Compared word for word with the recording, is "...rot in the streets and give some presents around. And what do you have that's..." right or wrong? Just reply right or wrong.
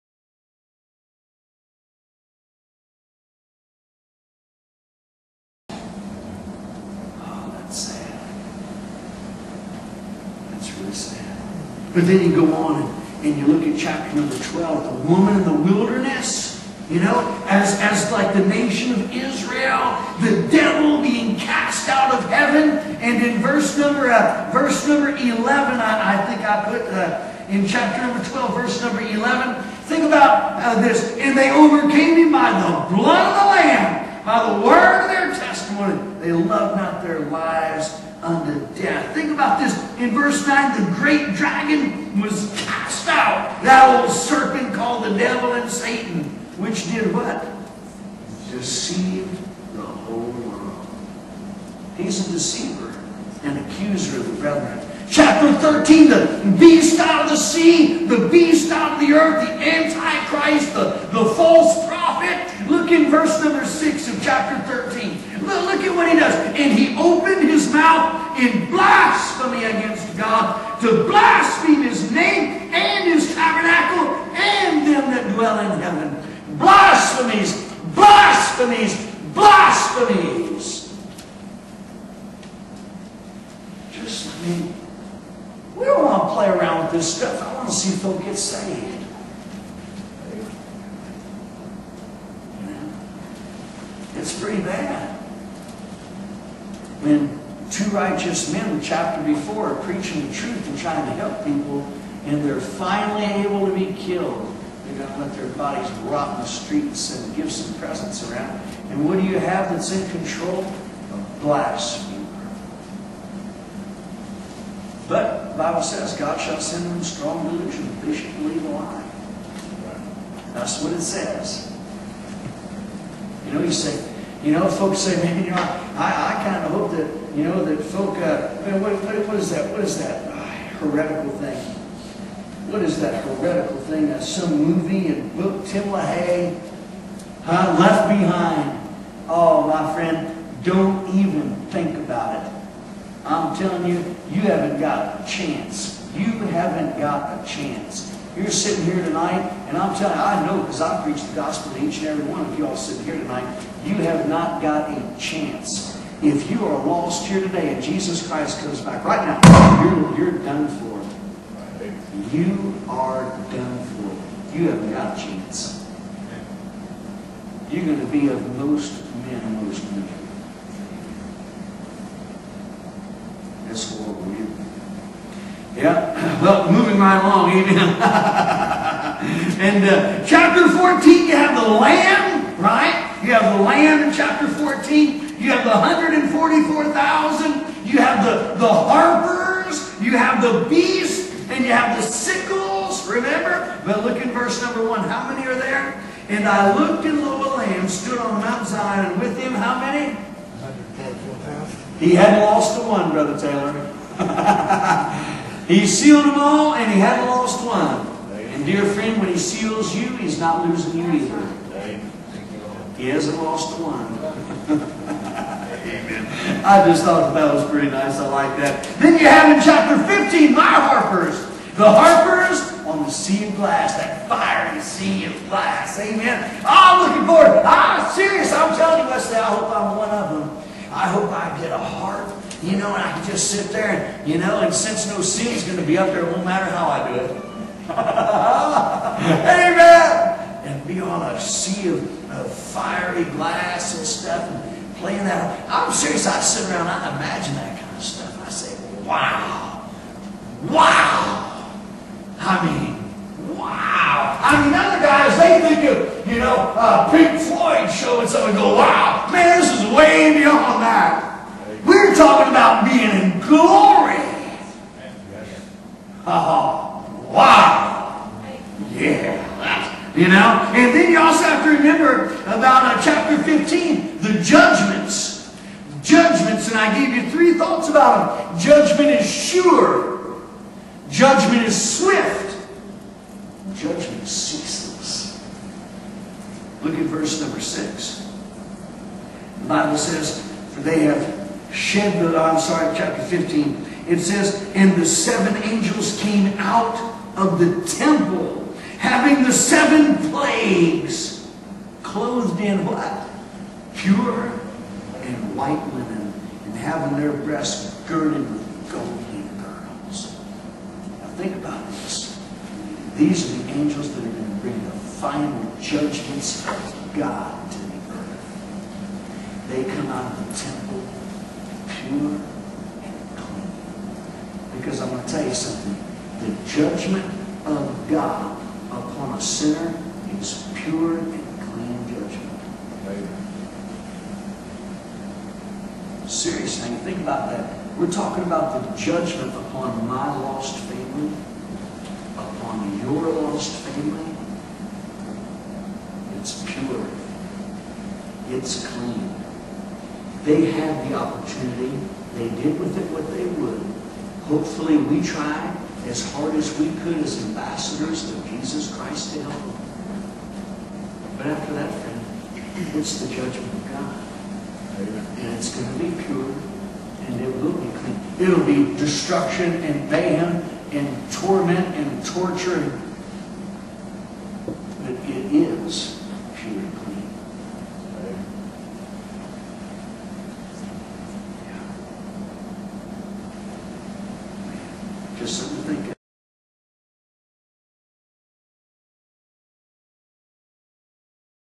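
right.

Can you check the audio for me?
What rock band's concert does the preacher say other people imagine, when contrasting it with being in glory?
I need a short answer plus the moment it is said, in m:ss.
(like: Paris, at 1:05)
Pink Floyd, at 4:17.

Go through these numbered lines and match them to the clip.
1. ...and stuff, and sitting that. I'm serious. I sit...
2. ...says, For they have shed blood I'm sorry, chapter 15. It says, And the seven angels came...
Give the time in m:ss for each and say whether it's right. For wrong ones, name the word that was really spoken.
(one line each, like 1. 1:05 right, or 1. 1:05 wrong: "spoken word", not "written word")
1. 4:03 wrong: "playing", not "sitting"
2. 4:49 right.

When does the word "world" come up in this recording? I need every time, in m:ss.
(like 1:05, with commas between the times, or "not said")
0:50, 2:53.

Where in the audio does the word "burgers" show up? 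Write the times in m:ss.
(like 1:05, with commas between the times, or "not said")
not said.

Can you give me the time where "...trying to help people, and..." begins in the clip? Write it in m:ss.
1:40.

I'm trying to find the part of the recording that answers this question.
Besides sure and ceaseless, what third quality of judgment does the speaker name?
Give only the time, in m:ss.
4:41.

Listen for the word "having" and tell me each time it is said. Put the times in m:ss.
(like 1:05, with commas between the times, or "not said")
4:58, 5:06.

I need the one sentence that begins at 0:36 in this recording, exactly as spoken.
They love not their lives unto death.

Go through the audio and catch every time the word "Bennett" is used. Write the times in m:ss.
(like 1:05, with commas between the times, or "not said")
not said.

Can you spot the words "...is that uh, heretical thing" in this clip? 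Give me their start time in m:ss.
2:09.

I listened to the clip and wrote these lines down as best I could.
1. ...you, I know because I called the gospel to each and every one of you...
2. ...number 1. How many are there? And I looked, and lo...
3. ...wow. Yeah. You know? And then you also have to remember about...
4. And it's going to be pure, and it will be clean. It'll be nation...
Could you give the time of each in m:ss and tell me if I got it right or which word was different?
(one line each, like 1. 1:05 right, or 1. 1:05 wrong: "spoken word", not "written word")
1. 2:30 wrong: "preached", not "called"
2. 3:14 right
3. 4:27 right
4. 6:05 wrong: "destruction", not "nation".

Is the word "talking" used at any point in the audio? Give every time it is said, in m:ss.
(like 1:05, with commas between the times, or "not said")
4:22, 5:38.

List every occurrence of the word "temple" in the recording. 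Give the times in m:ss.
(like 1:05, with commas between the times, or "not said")
4:57, 5:20.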